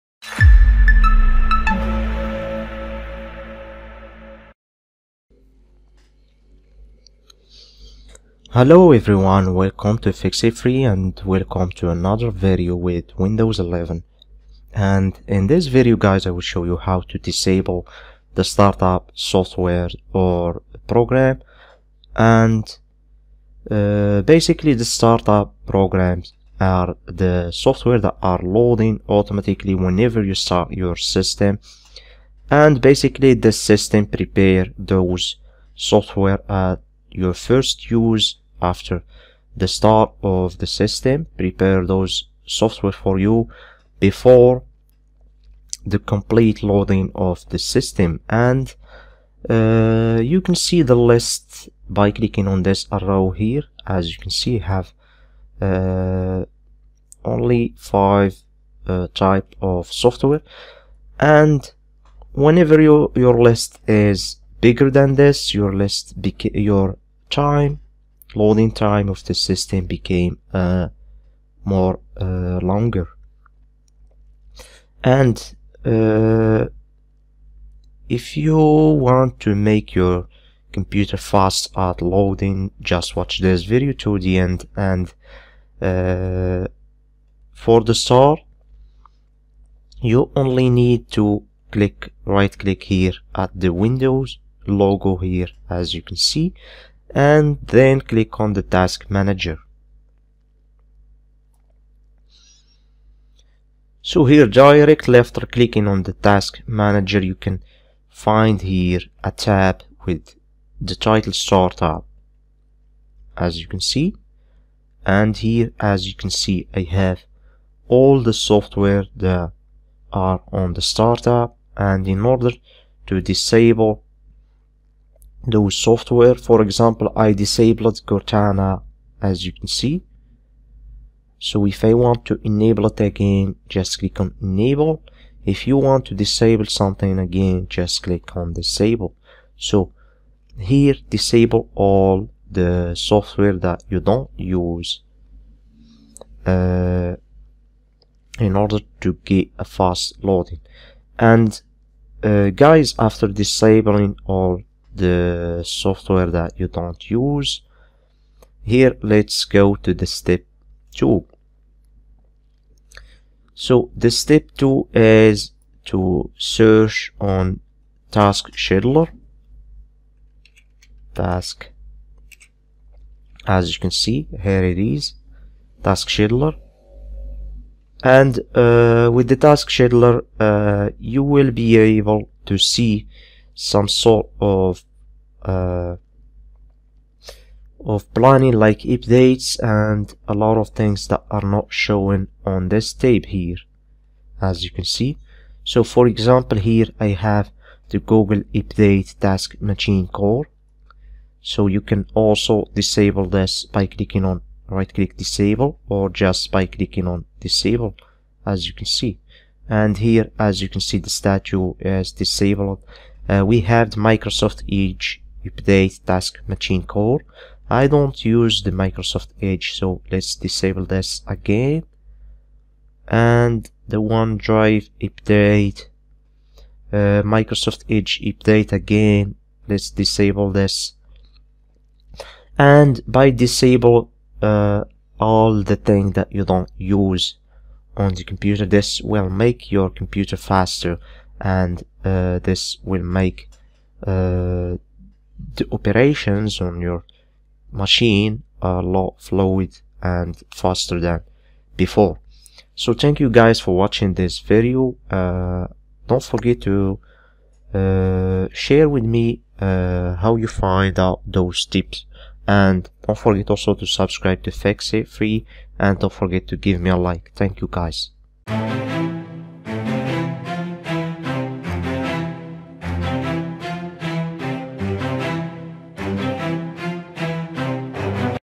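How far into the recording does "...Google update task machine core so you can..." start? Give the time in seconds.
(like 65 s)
197 s.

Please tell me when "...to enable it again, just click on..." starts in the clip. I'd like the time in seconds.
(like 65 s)
132 s.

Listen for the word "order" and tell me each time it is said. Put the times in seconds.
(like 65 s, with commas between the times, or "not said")
122 s, 148 s.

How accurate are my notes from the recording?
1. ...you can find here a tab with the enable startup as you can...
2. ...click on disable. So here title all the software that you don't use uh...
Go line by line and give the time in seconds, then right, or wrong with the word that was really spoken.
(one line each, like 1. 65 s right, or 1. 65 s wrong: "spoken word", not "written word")
1. 107 s wrong: "title", not "enable"
2. 138 s wrong: "disable", not "title".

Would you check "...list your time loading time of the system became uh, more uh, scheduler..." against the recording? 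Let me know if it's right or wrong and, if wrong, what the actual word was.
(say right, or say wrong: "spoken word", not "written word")
wrong: "longer", not "scheduler".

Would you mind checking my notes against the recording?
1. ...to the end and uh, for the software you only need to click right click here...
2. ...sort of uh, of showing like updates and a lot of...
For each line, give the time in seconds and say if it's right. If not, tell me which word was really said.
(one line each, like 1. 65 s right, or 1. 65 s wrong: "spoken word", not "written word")
1. 83 s wrong: "store", not "software"
2. 183 s wrong: "planning", not "showing".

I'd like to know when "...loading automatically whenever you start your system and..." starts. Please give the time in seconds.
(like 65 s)
28 s.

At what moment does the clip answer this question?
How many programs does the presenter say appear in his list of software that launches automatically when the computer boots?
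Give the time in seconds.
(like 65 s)
57 s.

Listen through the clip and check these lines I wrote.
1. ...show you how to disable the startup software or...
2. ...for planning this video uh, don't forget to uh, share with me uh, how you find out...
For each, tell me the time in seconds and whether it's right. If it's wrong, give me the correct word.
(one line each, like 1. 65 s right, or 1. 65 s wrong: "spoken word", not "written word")
1. 16 s right
2. 253 s wrong: "watching", not "planning".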